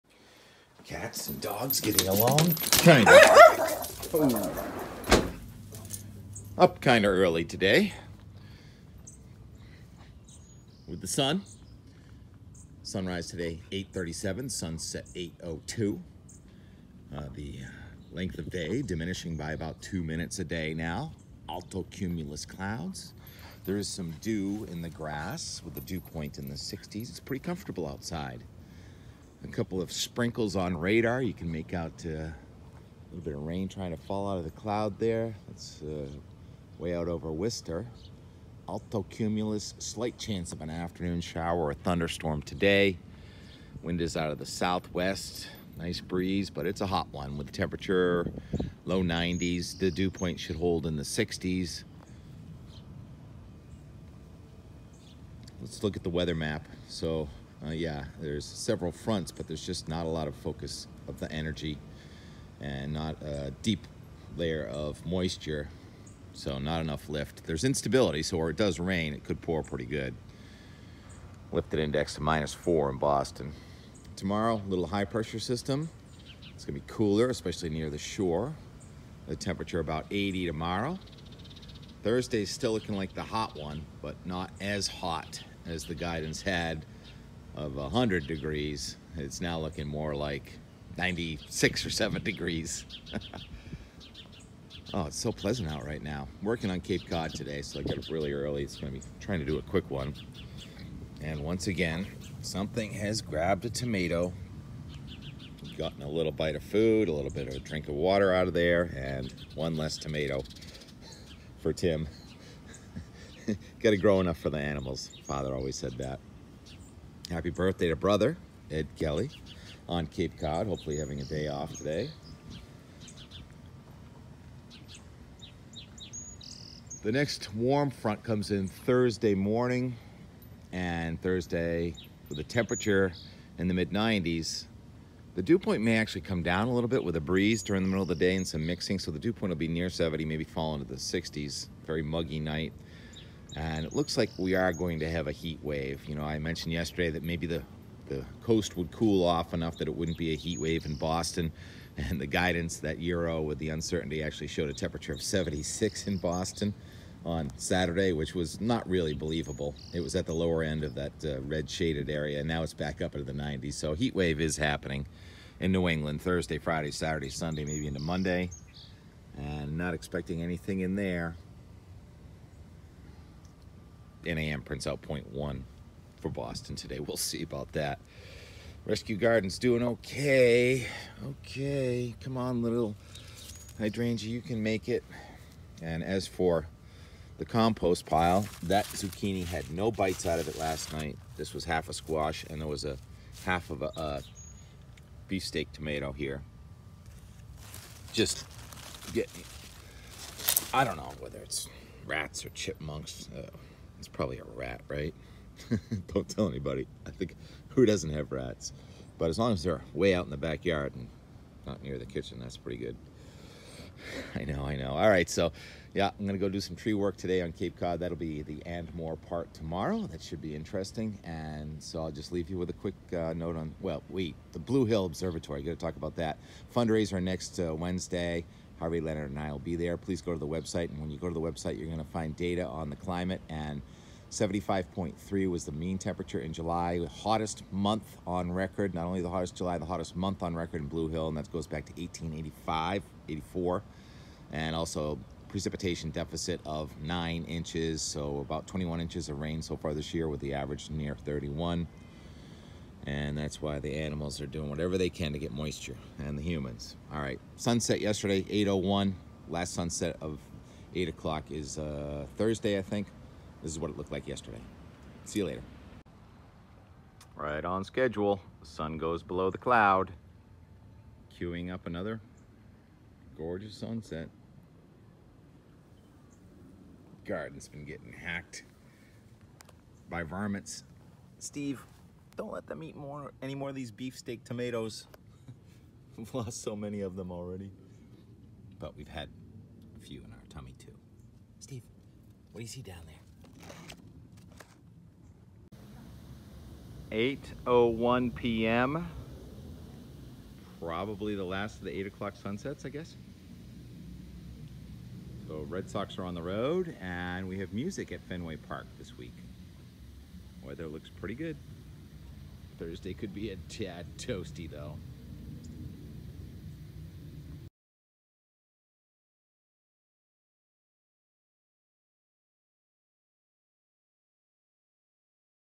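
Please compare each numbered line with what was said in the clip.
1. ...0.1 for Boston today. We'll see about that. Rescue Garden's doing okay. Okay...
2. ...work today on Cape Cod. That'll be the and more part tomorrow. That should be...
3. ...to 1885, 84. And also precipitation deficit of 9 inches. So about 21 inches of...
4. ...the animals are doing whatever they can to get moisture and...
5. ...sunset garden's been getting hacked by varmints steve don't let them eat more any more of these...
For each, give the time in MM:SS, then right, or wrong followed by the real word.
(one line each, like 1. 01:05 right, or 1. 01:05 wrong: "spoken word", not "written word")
1. 02:55 right
2. 03:36 right
3. 04:01 right
4. 04:13 right
5. 04:33 right.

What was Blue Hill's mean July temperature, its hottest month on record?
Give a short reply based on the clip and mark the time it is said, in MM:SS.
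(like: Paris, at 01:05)
75.3, at 03:54.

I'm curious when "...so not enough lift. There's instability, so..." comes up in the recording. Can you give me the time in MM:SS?
01:06.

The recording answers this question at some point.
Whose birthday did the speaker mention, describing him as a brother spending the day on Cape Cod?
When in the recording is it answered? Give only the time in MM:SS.
01:58.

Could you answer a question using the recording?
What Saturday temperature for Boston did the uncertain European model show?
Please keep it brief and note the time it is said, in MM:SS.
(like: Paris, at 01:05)
76, at 02:35.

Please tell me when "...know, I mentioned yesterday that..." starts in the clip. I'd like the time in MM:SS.
02:26.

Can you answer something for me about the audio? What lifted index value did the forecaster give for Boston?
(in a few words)
-4.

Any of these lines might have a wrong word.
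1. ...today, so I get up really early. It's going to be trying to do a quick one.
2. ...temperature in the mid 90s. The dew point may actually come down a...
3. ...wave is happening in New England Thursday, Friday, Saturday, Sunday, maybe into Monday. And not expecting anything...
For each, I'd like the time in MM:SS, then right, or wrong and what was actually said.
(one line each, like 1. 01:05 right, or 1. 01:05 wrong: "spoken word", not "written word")
1. 01:37 right
2. 02:12 right
3. 02:44 right.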